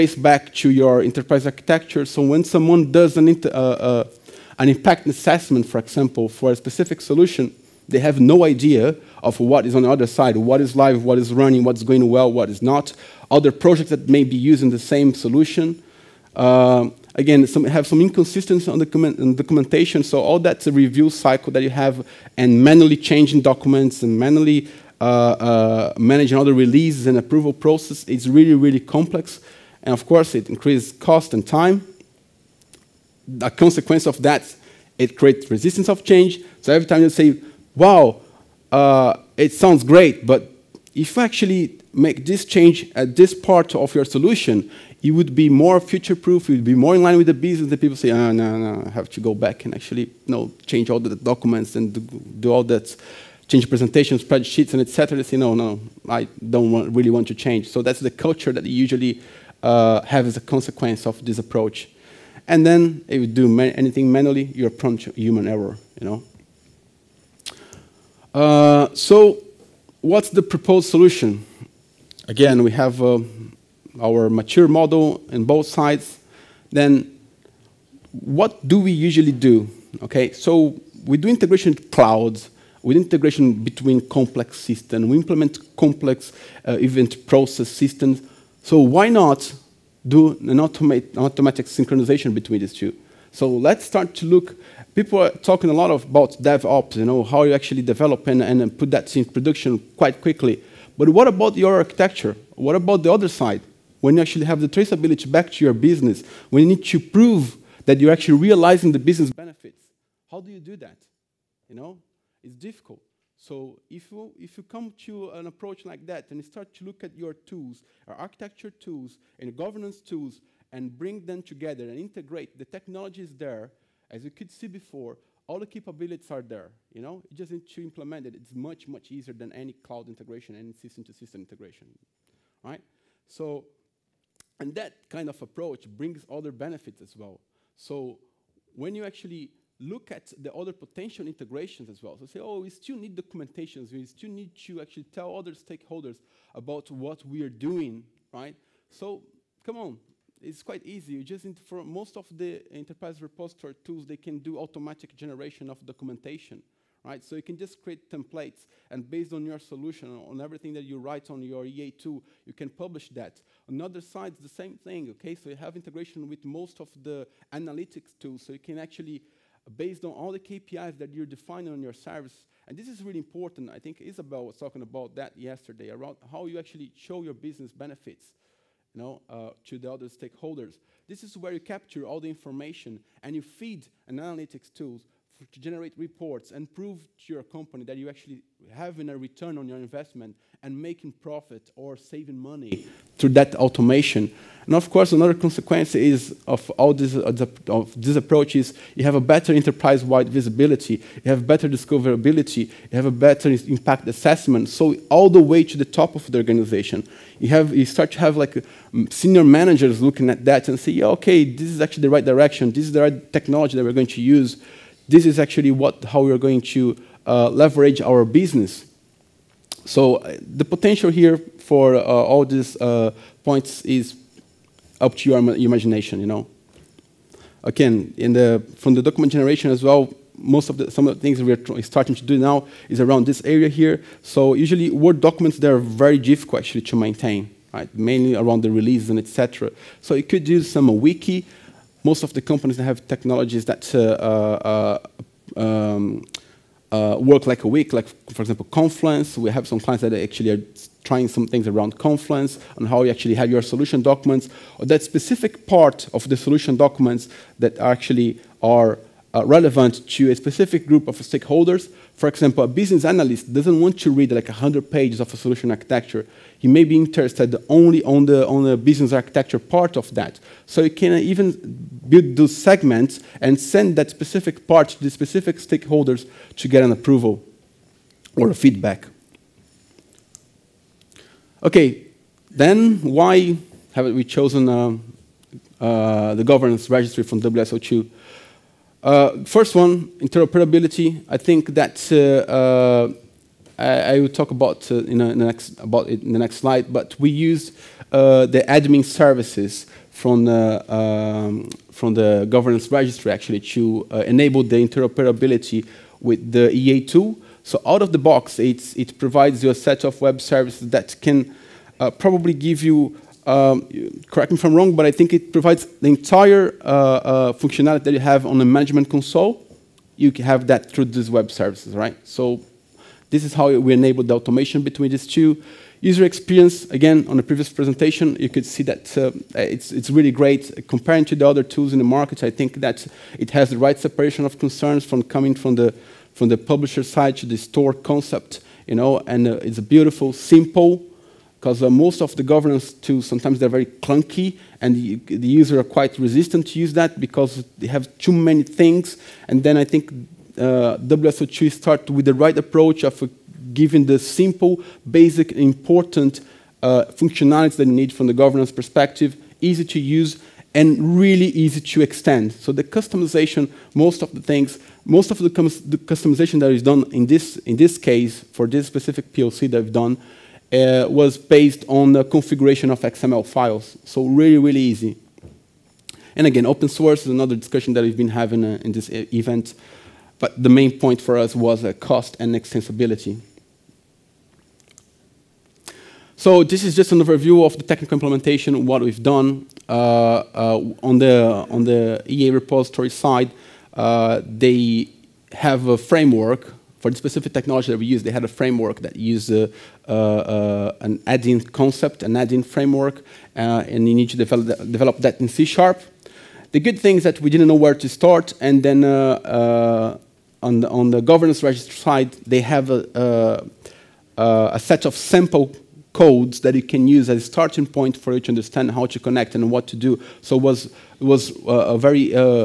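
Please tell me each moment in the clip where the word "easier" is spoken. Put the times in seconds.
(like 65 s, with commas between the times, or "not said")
129 s.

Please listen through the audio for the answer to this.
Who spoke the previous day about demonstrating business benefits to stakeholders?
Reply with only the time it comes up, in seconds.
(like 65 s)
174 s.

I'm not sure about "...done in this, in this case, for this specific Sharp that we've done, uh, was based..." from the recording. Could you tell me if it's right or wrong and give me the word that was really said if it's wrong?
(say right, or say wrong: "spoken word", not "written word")
wrong: "PLC", not "Sharp".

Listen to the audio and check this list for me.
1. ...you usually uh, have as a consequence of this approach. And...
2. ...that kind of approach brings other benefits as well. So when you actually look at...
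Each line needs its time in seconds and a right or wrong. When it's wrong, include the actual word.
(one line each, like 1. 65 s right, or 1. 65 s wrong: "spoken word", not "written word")
1. 58 s right
2. 134 s right.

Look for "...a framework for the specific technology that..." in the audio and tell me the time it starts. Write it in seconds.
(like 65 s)
395 s.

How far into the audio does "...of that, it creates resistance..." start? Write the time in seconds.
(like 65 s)
34 s.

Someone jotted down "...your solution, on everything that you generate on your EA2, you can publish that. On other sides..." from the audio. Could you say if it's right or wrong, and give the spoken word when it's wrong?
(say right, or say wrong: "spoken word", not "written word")
wrong: "write", not "generate".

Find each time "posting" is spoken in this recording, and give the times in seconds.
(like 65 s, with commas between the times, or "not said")
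not said.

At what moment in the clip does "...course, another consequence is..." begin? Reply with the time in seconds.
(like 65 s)
194 s.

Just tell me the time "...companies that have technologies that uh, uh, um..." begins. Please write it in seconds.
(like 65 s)
242 s.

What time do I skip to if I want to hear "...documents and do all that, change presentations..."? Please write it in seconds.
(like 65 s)
51 s.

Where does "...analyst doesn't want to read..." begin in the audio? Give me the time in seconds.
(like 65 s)
263 s.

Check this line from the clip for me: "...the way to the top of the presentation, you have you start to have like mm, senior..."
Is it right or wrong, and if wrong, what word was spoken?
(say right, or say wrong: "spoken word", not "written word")
wrong: "organization", not "presentation".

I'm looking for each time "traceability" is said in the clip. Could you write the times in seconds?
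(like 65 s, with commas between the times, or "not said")
104 s.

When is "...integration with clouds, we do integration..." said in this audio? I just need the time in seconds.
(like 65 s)
81 s.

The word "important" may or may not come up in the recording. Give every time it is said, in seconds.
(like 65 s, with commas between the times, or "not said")
173 s, 355 s.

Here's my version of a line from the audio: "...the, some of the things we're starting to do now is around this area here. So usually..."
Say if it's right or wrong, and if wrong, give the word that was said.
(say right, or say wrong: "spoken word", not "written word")
right.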